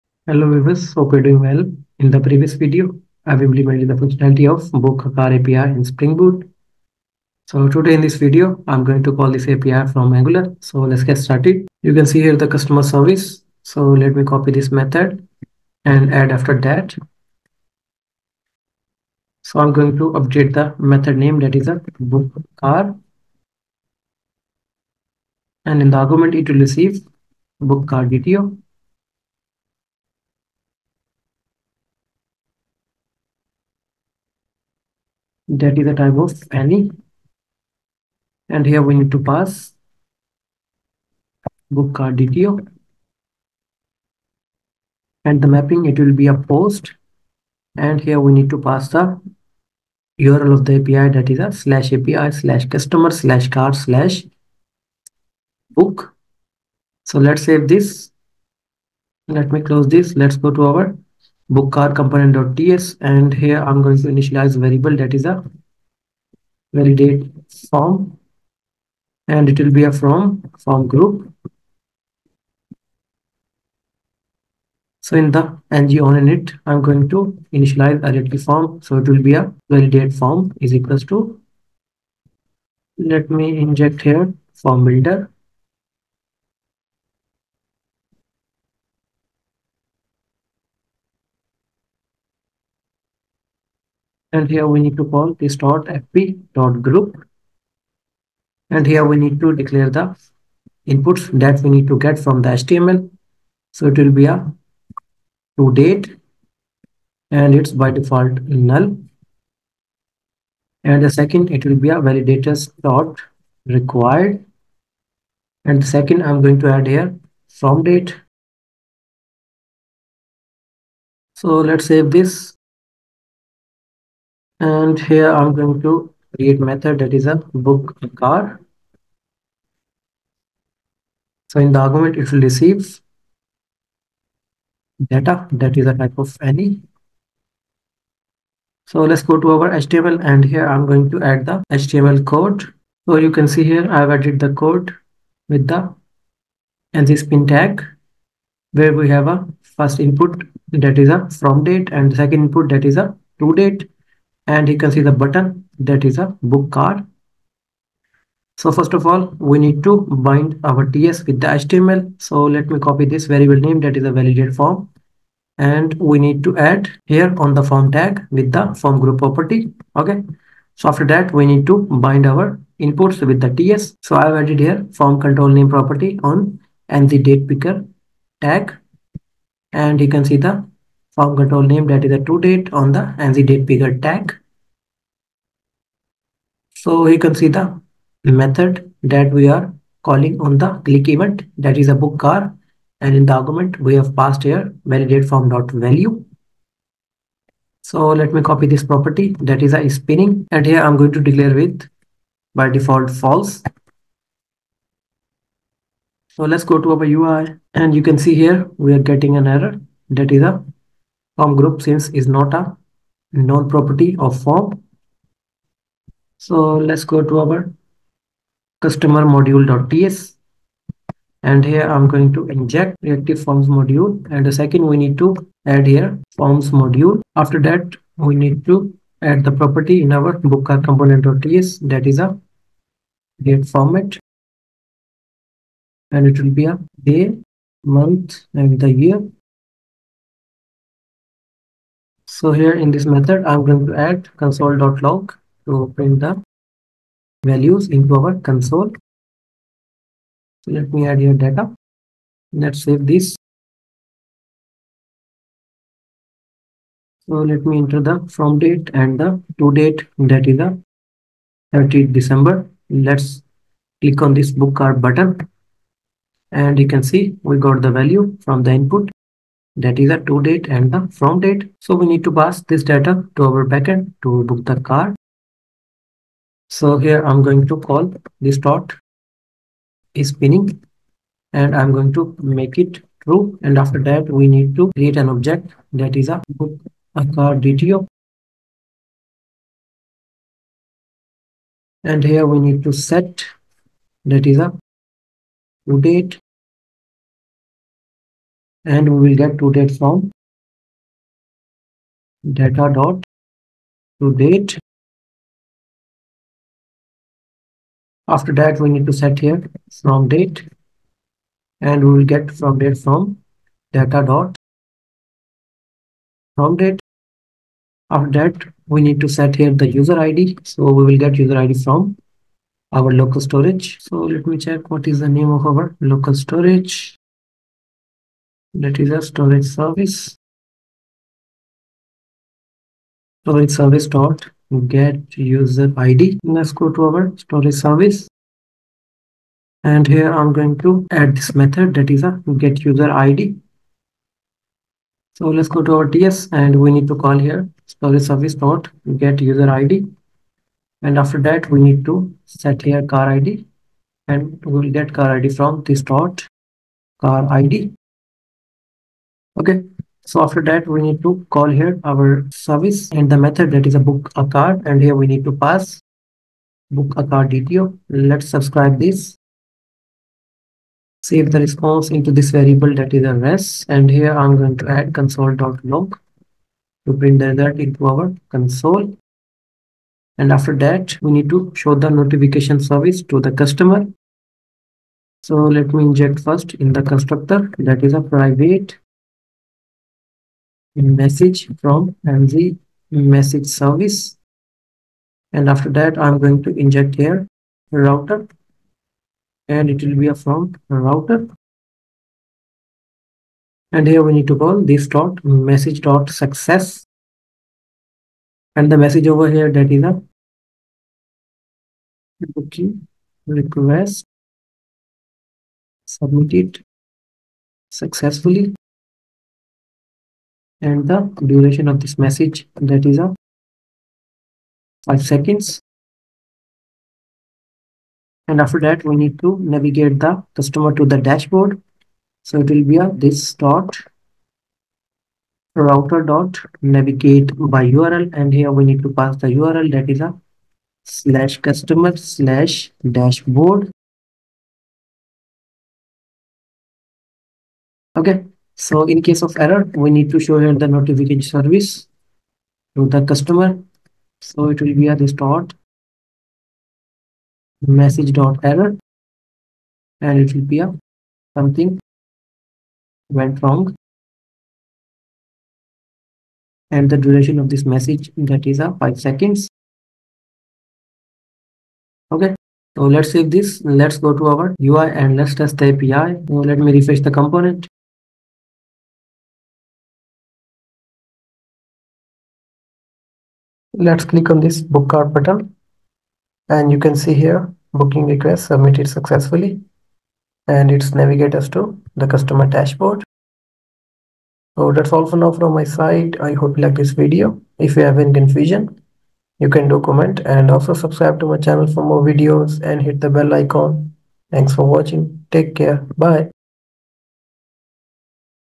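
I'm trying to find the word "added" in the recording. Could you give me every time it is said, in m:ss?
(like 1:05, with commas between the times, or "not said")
2:24, 2:54.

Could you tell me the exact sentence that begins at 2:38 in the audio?
So first of all, we need to bind our TS with the HTML.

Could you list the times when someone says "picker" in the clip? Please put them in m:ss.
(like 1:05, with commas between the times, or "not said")
2:57, 3:03.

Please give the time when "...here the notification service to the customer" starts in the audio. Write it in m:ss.
7:30.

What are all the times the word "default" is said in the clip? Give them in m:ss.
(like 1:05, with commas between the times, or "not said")
1:47, 3:22.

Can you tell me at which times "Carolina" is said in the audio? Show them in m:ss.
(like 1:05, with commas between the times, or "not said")
not said.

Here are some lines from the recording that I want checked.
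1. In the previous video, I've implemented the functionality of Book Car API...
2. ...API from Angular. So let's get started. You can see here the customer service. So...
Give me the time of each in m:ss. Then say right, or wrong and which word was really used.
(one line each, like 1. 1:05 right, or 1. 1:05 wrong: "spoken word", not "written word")
1. 0:01 right
2. 0:09 right.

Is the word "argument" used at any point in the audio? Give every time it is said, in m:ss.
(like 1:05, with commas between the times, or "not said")
0:25, 2:11, 3:13.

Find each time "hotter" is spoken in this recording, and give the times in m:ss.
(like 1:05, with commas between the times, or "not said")
not said.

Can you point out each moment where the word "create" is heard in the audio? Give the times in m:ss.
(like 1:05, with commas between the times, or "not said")
2:06, 4:44.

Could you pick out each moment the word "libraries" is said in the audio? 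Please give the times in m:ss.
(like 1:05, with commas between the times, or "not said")
not said.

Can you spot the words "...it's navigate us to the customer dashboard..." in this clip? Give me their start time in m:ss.
8:10.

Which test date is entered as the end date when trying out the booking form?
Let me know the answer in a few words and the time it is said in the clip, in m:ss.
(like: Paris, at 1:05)
30th December, at 4:21.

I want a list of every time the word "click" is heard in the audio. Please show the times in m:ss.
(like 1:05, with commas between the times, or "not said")
3:10, 4:24, 8:04.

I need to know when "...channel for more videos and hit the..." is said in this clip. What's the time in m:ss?
8:21.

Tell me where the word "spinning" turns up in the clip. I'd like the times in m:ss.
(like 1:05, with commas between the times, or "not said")
3:19, 4:40.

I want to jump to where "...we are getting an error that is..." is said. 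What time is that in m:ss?
3:28.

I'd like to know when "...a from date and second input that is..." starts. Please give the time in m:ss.
2:31.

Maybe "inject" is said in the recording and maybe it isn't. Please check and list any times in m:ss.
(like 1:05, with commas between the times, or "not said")
1:23, 3:42, 6:26, 6:36.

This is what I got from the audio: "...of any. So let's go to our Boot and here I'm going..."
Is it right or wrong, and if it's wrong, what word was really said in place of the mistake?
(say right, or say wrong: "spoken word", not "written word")
wrong: "HTML", not "Boot".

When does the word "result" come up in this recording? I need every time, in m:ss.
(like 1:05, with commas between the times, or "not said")
6:17.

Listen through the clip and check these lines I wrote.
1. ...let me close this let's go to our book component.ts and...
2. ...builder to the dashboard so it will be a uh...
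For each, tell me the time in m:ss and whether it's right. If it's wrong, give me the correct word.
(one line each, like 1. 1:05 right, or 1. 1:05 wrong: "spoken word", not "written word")
1. 0:59 right
2. 7:10 wrong: "customer", not "builder".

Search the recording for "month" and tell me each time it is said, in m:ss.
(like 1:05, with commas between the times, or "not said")
3:57.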